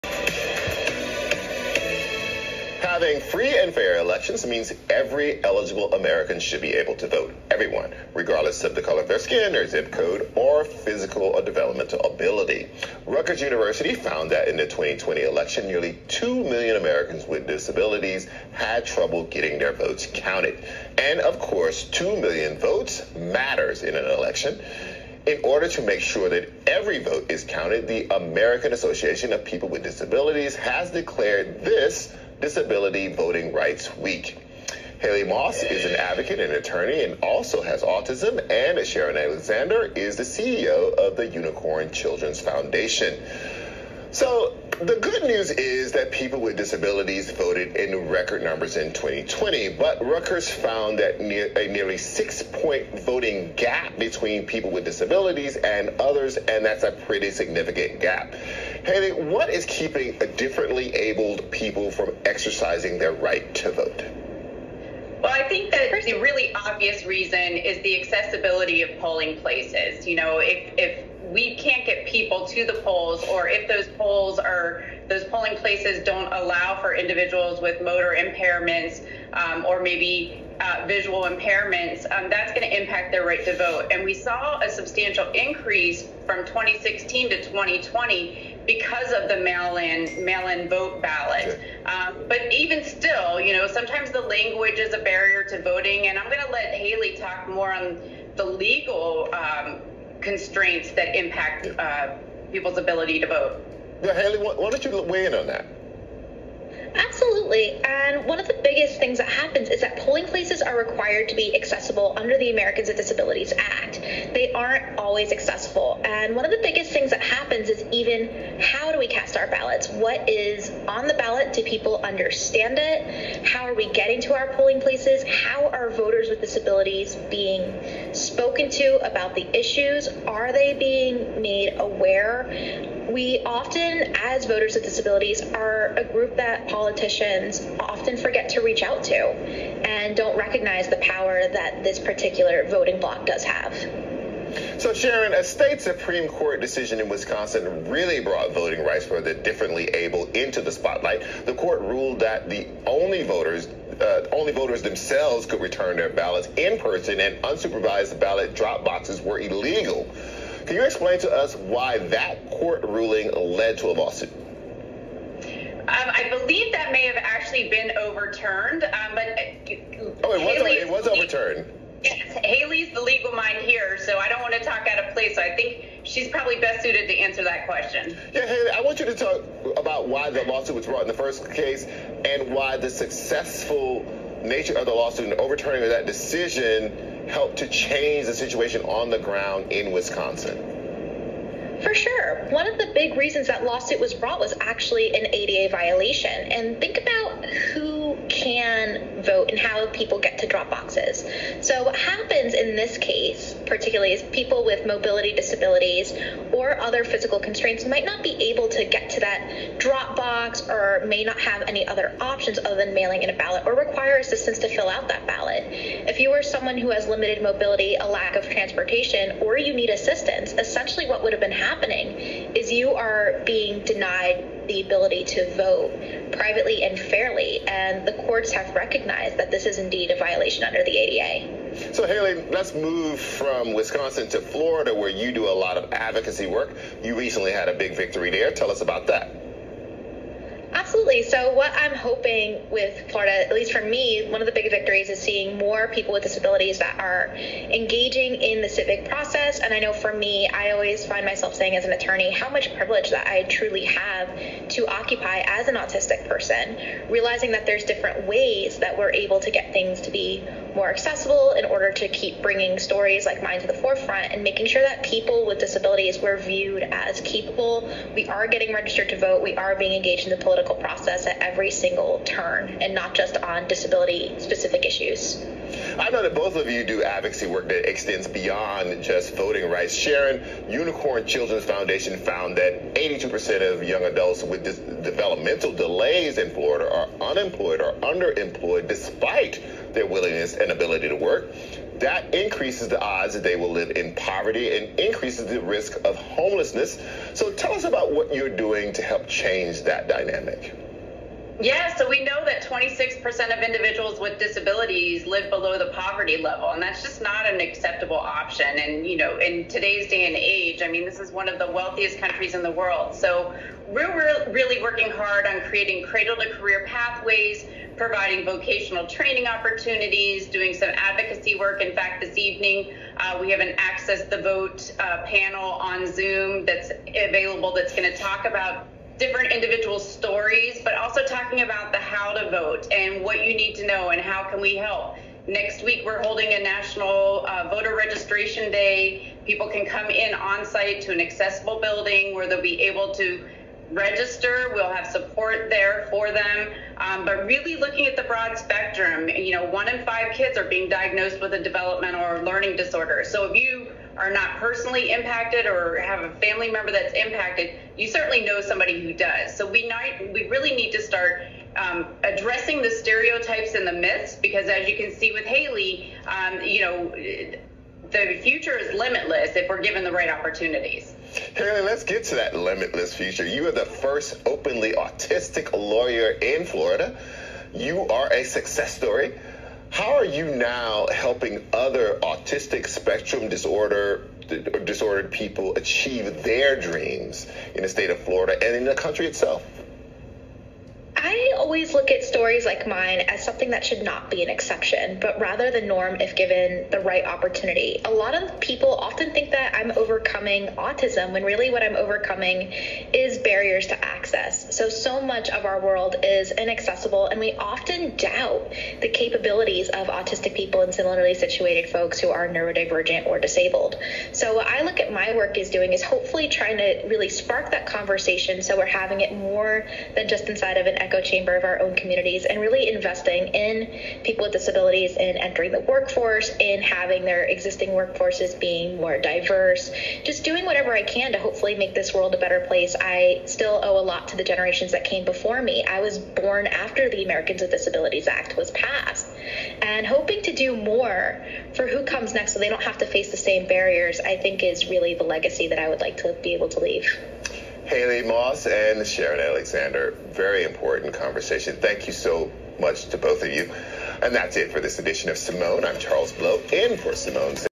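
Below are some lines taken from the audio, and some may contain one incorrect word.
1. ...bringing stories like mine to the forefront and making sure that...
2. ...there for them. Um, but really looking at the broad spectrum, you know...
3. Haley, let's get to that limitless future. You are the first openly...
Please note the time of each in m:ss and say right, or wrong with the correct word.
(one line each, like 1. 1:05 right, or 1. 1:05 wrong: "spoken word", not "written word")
1. 4:22 right
2. 5:45 right
3. 6:11 right.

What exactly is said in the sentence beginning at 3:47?
And the courts have recognized that this is indeed a violation under the ADA.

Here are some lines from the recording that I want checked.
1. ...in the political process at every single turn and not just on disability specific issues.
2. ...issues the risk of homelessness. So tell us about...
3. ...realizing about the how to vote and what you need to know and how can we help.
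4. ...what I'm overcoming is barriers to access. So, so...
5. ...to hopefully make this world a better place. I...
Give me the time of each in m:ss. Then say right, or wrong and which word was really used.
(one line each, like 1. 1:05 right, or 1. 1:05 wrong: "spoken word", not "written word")
1. 4:30 right
2. 4:54 wrong: "increases", not "issues"
3. 5:31 wrong: "talking", not "realizing"
4. 6:41 right
5. 7:11 right.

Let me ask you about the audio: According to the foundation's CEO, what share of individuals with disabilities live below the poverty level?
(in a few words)
26%.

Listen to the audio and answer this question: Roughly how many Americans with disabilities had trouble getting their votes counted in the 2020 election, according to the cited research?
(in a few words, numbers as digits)
nearly 2 million.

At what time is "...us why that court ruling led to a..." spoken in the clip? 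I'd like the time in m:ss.
2:41.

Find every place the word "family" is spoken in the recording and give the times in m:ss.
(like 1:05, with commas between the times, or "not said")
5:56.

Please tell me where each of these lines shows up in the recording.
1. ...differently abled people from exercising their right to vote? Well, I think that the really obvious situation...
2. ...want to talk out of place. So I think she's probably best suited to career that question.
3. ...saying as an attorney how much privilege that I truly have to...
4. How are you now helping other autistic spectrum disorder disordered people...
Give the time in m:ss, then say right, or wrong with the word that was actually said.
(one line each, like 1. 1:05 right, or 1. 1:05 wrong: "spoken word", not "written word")
1. 1:00 wrong: "reason", not "situation"
2. 2:54 wrong: "answer", not "career"
3. 4:11 right
4. 6:19 right.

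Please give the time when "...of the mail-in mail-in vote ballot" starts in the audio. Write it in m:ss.
1:29.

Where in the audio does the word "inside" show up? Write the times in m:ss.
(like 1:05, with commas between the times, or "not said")
7:00.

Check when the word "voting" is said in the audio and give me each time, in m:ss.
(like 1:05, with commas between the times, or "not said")
0:33, 0:53, 1:35, 2:22, 2:28, 4:39.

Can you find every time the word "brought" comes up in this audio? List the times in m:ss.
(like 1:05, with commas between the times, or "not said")
2:28, 3:00, 3:14.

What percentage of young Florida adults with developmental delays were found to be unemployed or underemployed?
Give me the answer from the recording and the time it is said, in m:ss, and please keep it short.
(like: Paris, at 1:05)
82%, at 4:42.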